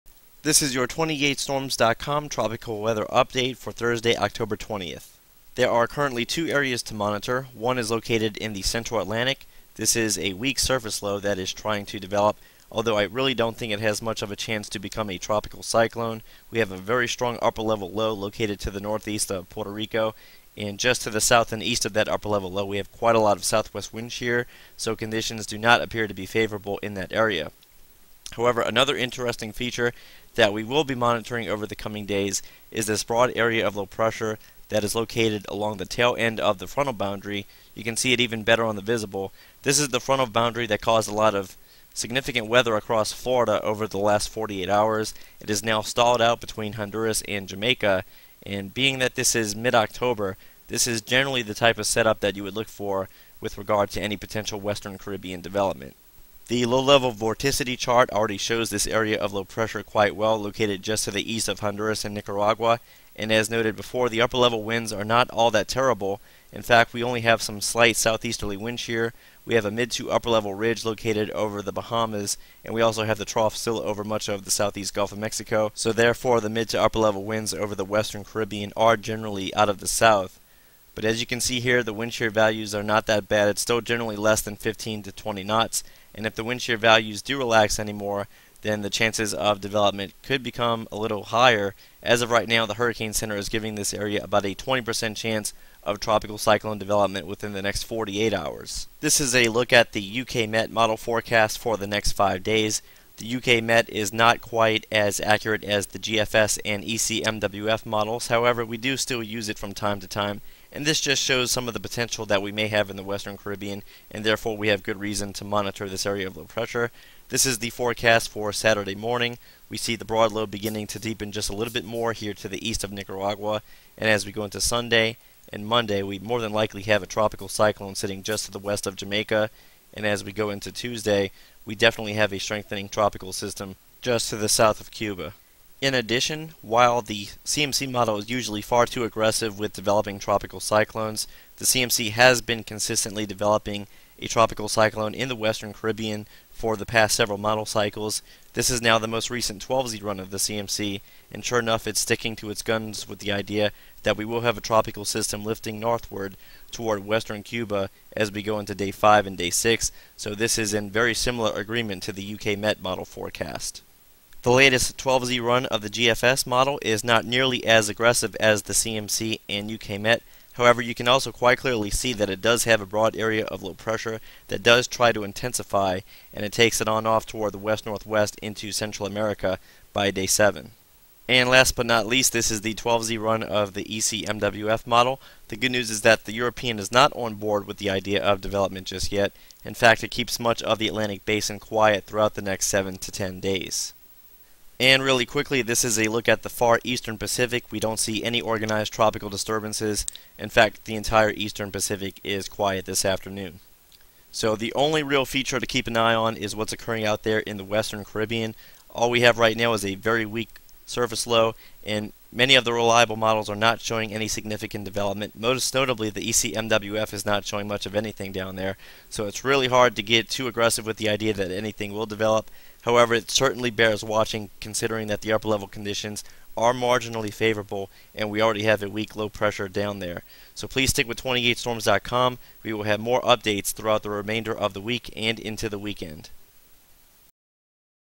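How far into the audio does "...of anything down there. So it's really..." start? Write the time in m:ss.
3:37.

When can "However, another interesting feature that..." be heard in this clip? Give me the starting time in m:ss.
0:28.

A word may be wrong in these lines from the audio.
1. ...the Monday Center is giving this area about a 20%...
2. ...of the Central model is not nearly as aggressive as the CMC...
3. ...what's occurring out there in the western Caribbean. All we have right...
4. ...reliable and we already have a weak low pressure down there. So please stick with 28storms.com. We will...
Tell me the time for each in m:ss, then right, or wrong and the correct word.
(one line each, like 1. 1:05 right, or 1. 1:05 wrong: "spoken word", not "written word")
1. 1:32 wrong: "Hurricane", not "Monday"
2. 2:45 wrong: "GFS", not "Central"
3. 3:26 right
4. 3:47 wrong: "favorable", not "reliable".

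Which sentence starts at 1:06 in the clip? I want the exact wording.
In fact, we only have some slight southeasterly wind shear.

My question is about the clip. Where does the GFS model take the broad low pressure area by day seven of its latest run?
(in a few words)
Central America.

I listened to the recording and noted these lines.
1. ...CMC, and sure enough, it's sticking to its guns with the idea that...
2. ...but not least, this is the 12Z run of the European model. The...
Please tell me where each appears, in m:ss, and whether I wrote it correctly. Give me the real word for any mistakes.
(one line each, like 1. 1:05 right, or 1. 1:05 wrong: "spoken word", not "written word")
1. 2:30 right
2. 3:01 wrong: "ECMWF", not "European".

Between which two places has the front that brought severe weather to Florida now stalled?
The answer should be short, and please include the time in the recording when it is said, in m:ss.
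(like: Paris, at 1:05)
Honduras and Jamaica, at 0:46.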